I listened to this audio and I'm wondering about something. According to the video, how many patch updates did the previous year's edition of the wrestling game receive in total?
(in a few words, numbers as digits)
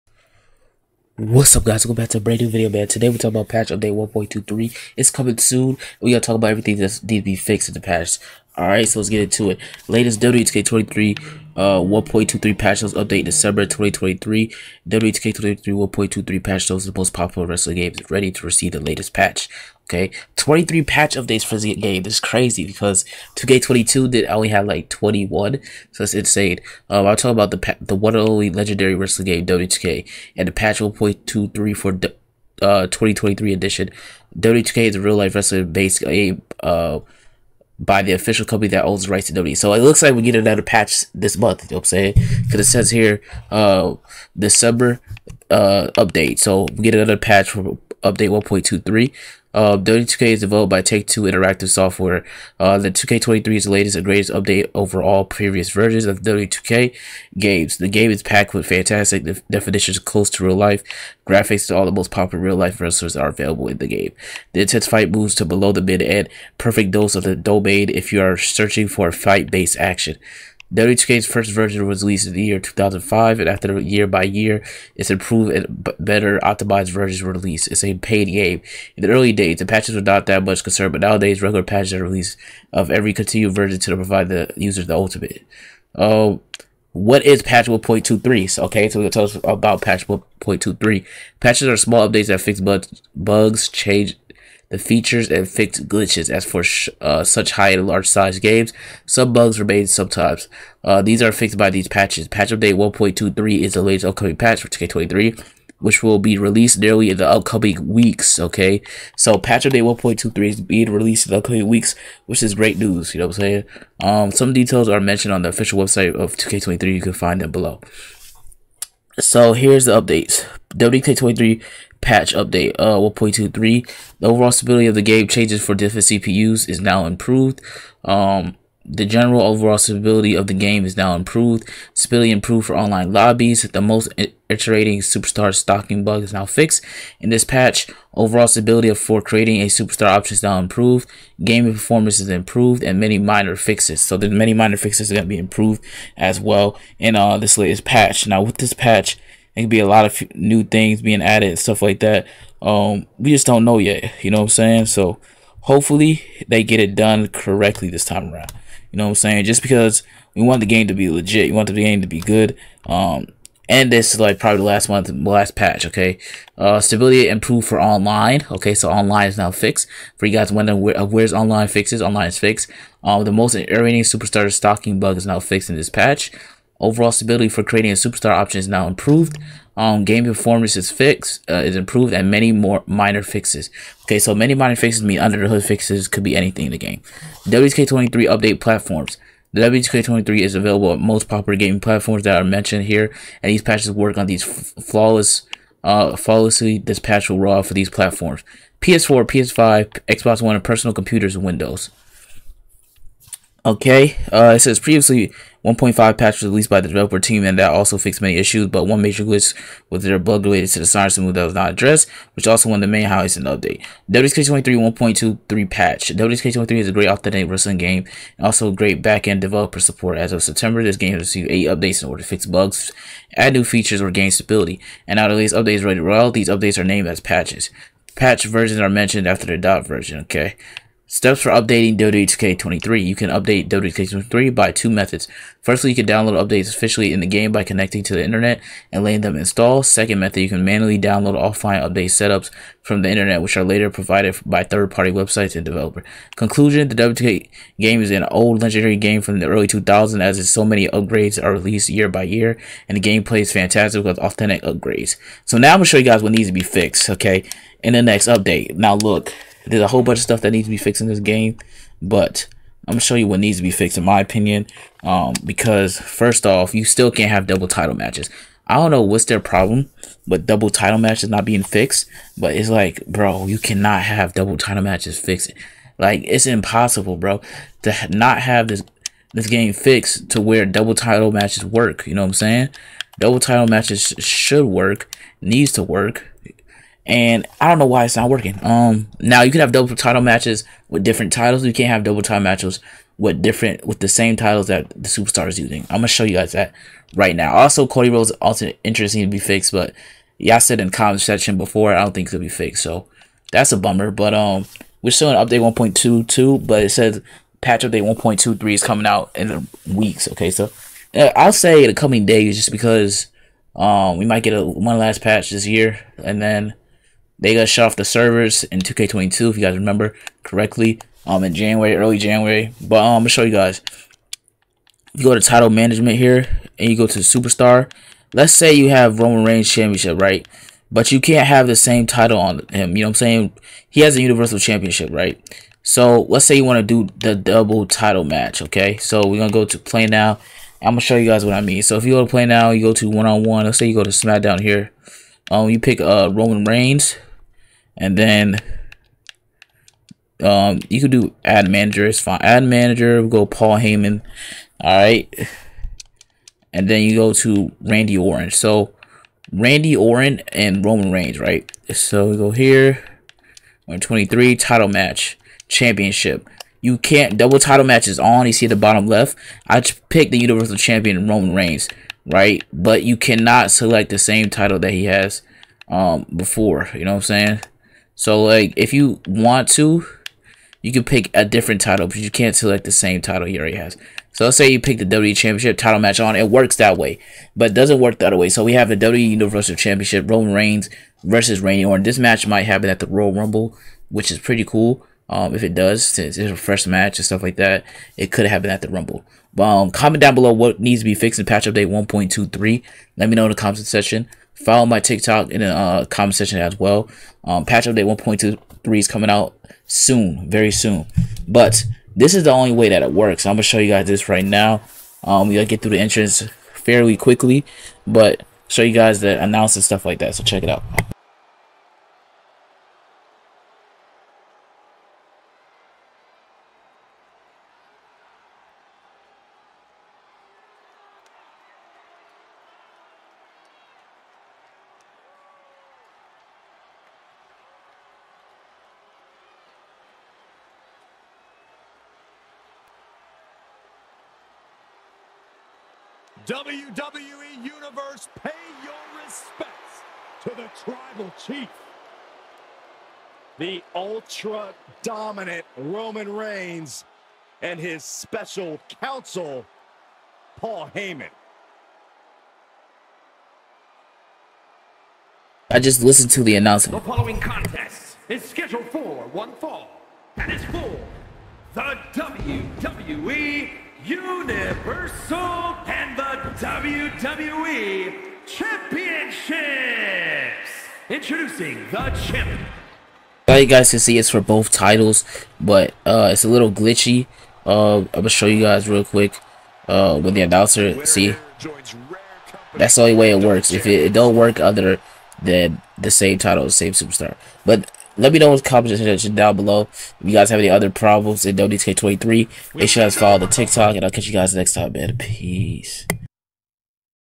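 21.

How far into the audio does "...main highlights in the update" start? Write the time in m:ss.
3:32.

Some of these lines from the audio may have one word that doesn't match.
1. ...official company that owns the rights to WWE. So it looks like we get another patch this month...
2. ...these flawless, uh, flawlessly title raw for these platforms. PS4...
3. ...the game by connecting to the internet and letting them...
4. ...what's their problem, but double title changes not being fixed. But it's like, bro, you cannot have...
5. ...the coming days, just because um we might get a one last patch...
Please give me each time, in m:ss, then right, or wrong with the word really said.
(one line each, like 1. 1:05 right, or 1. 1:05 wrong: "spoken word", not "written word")
1. 0:38 right
2. 3:14 wrong: "dispatchable", not "title"
3. 3:57 right
4. 4:29 wrong: "matches", not "changes"
5. 5:11 right.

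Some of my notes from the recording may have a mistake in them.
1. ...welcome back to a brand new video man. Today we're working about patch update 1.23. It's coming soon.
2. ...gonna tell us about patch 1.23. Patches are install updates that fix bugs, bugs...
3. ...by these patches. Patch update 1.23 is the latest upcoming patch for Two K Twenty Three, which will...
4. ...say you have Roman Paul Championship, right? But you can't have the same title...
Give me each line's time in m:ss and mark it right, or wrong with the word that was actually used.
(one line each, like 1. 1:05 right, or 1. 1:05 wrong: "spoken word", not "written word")
1. 0:01 wrong: "talking", not "working"
2. 1:28 wrong: "small", not "install"
3. 1:41 right
4. 5:28 wrong: "Reigns", not "Paul".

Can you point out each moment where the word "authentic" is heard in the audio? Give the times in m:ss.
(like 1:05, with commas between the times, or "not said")
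3:37, 4:14.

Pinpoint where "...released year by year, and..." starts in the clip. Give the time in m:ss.
4:11.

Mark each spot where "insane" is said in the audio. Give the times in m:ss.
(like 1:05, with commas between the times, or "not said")
0:26.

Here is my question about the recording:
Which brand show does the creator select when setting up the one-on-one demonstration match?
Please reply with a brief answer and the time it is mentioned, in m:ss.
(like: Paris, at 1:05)
SmackDown, at 5:44.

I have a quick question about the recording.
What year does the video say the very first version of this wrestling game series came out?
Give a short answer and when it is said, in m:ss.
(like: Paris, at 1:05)
2005, at 1:12.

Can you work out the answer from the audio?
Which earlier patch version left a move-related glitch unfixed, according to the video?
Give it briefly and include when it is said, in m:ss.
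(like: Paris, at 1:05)
1.5, at 3:25.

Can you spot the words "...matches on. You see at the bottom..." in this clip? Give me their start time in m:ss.
6:07.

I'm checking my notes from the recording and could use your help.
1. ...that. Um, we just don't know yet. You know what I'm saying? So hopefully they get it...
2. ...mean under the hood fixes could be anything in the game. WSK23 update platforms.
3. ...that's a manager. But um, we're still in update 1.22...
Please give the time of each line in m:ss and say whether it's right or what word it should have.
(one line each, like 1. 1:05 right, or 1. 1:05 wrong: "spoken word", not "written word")
1. 2:32 right
2. 3:05 right
3. 5:03 wrong: "bummer", not "manager".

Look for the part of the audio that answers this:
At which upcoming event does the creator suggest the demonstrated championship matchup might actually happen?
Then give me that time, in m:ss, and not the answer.
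6:33.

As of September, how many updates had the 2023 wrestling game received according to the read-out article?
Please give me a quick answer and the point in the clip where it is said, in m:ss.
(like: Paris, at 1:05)
8, at 3:41.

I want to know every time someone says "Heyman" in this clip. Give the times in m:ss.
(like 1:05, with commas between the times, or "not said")
5:53, 7:40.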